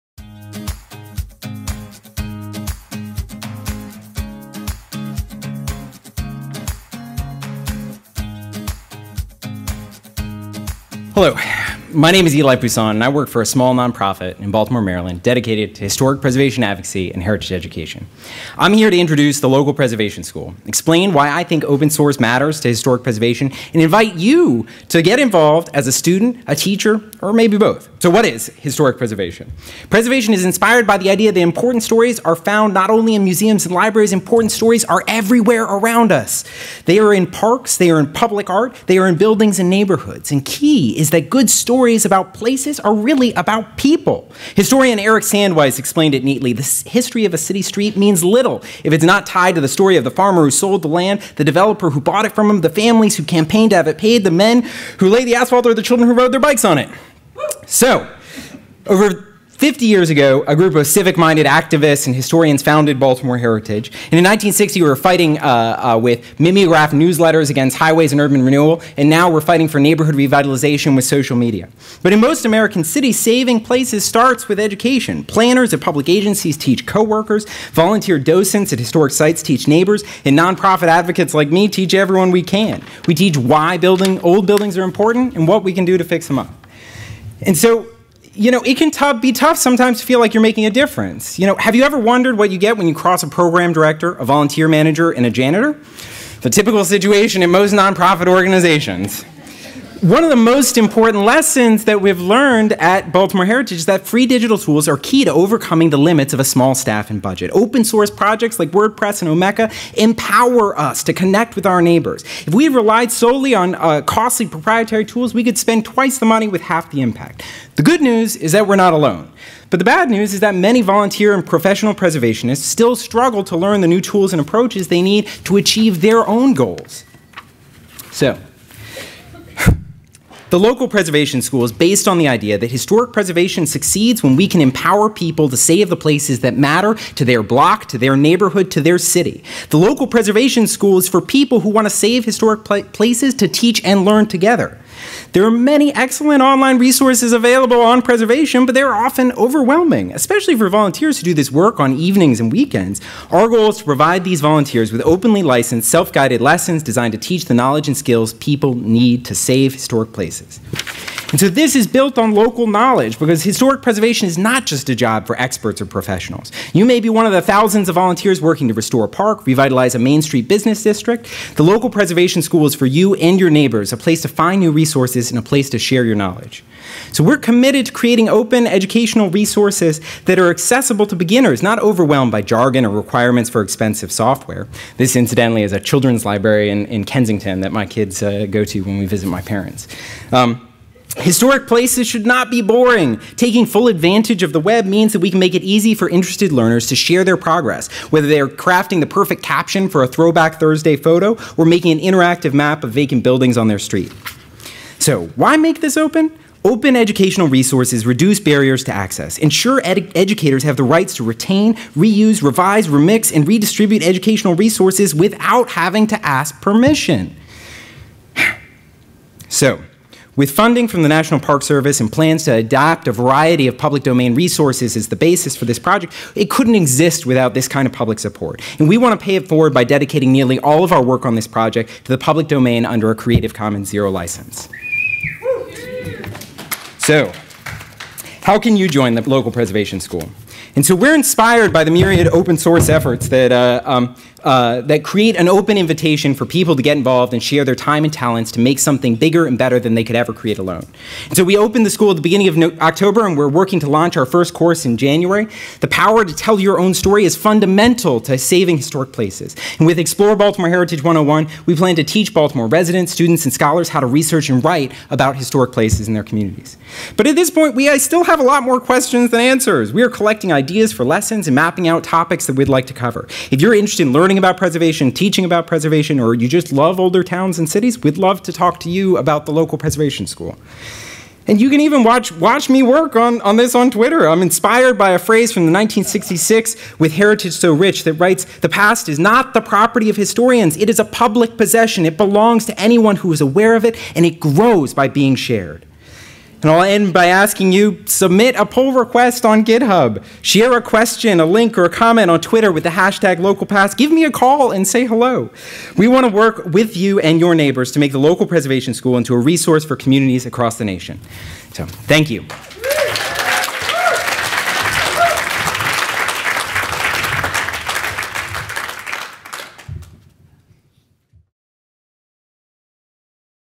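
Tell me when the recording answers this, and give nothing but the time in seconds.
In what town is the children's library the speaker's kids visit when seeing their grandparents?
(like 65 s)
187 s.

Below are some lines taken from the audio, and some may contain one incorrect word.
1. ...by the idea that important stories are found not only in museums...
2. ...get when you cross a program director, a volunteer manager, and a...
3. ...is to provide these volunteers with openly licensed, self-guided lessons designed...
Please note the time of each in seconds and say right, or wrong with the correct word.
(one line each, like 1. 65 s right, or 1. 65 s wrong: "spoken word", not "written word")
1. 30 s right
2. 92 s right
3. 153 s right.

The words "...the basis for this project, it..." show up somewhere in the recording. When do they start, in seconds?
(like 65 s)
225 s.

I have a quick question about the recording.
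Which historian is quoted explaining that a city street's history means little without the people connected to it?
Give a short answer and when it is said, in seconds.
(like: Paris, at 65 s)
Eric Sandweiss, at 44 s.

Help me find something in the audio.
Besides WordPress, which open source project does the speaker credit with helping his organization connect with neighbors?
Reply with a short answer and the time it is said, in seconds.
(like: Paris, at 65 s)
Omeka, at 109 s.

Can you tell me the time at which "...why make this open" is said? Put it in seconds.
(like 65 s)
205 s.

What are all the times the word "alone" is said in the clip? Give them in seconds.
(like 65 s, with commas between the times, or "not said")
118 s, 250 s.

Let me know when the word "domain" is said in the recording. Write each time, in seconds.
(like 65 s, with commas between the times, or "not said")
224 s, 232 s.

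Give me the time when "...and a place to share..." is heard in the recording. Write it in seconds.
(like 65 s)
175 s.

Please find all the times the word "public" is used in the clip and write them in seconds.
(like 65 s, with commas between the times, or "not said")
38 s, 75 s, 223 s, 227 s, 232 s, 291 s.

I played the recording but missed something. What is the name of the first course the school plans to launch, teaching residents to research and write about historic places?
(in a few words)
Explore Baltimore Heritage 101.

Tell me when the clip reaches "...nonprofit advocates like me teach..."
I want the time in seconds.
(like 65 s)
80 s.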